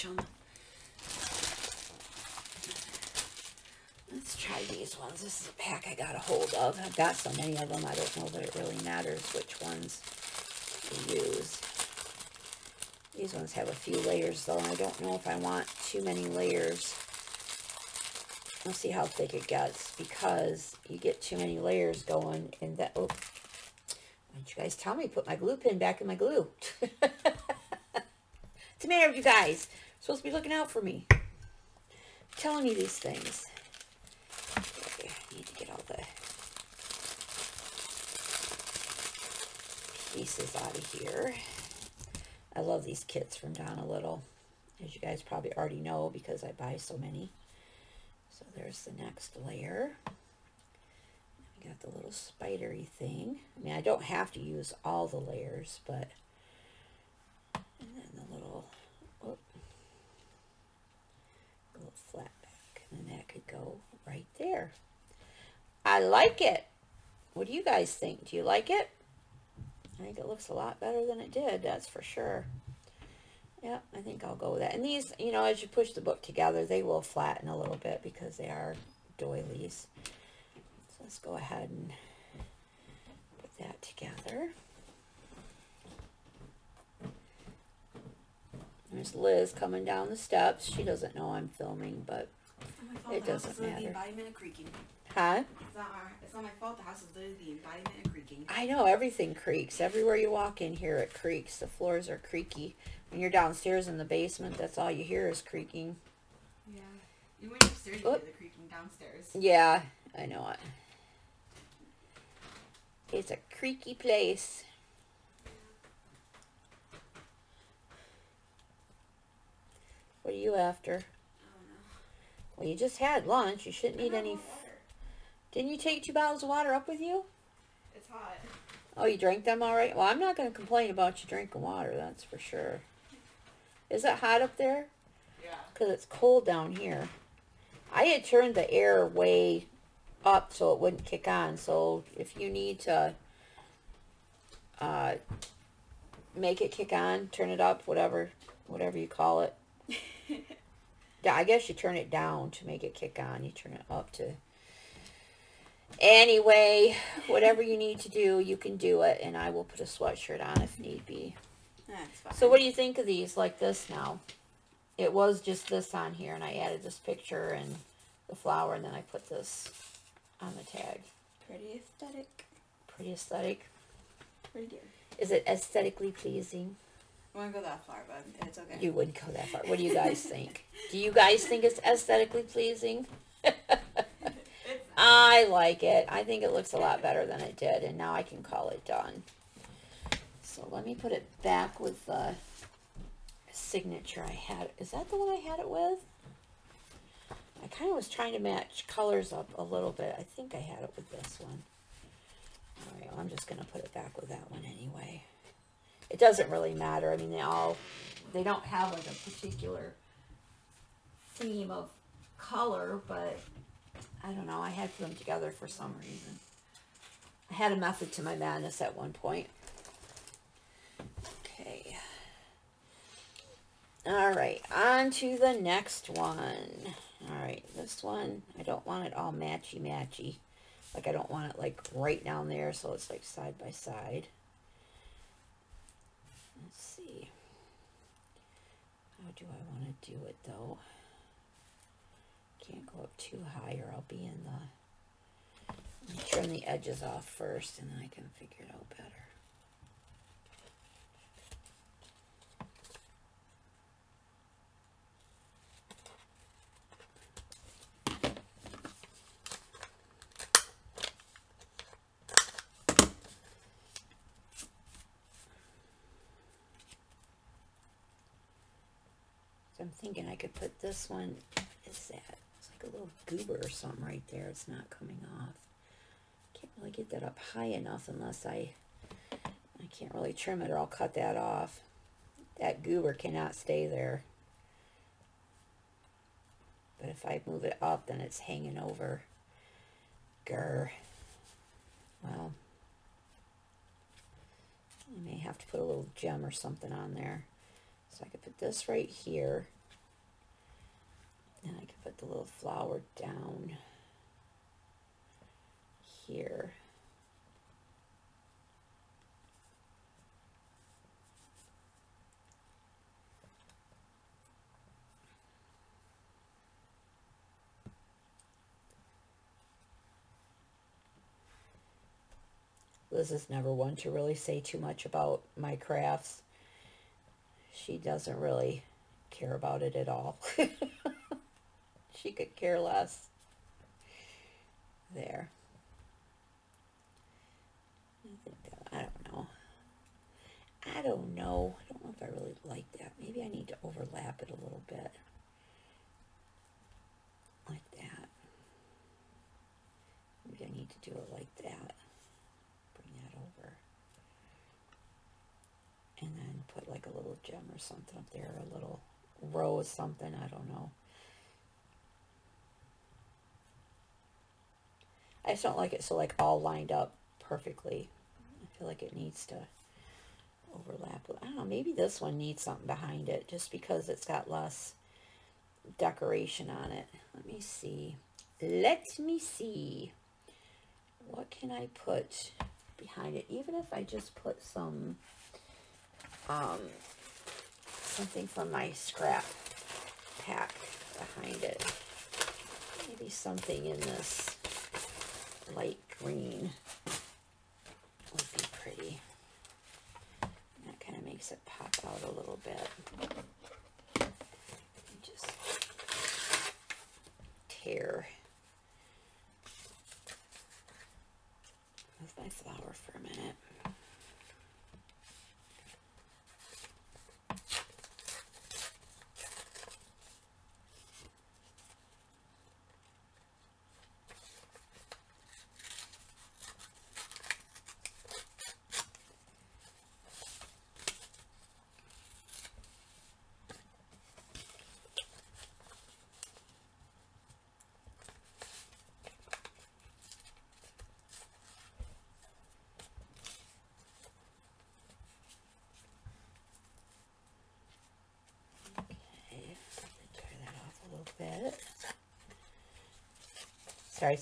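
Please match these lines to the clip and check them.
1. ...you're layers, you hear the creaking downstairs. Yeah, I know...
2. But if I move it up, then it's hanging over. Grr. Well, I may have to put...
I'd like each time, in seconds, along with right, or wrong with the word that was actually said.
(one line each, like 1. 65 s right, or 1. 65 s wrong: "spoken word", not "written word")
1. 107 s wrong: "upstairs", not "layers"
2. 286 s right.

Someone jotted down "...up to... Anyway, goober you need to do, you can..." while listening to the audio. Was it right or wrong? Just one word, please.
wrong.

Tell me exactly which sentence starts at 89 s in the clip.
There's Liz coming down the steps.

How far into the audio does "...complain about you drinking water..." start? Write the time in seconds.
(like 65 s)
130 s.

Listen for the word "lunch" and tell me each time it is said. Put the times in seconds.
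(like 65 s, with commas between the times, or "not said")
123 s.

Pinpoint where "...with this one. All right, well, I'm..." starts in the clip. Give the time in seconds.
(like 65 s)
200 s.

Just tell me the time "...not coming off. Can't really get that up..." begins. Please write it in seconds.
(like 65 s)
274 s.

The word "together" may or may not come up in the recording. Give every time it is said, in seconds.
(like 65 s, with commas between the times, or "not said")
76 s, 83 s, 215 s.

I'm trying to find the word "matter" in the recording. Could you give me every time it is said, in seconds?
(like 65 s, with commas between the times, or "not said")
8 s, 28 s, 93 s, 206 s.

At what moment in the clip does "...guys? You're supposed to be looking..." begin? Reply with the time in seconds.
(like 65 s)
29 s.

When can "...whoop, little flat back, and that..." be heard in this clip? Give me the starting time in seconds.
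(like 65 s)
59 s.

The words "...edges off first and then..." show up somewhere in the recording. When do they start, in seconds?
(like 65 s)
246 s.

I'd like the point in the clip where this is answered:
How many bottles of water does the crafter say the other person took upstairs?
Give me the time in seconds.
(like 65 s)
126 s.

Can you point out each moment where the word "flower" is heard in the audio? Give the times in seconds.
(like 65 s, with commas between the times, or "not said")
168 s, 302 s, 412 s.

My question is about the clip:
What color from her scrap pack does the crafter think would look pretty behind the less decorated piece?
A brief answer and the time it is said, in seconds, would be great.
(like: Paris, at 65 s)
light green, at 395 s.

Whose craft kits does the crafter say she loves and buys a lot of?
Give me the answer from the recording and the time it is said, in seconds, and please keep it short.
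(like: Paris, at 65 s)
Donna Little, at 43 s.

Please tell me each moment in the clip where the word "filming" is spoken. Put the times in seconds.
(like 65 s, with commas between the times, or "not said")
91 s.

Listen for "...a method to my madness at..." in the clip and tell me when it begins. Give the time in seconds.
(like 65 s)
217 s.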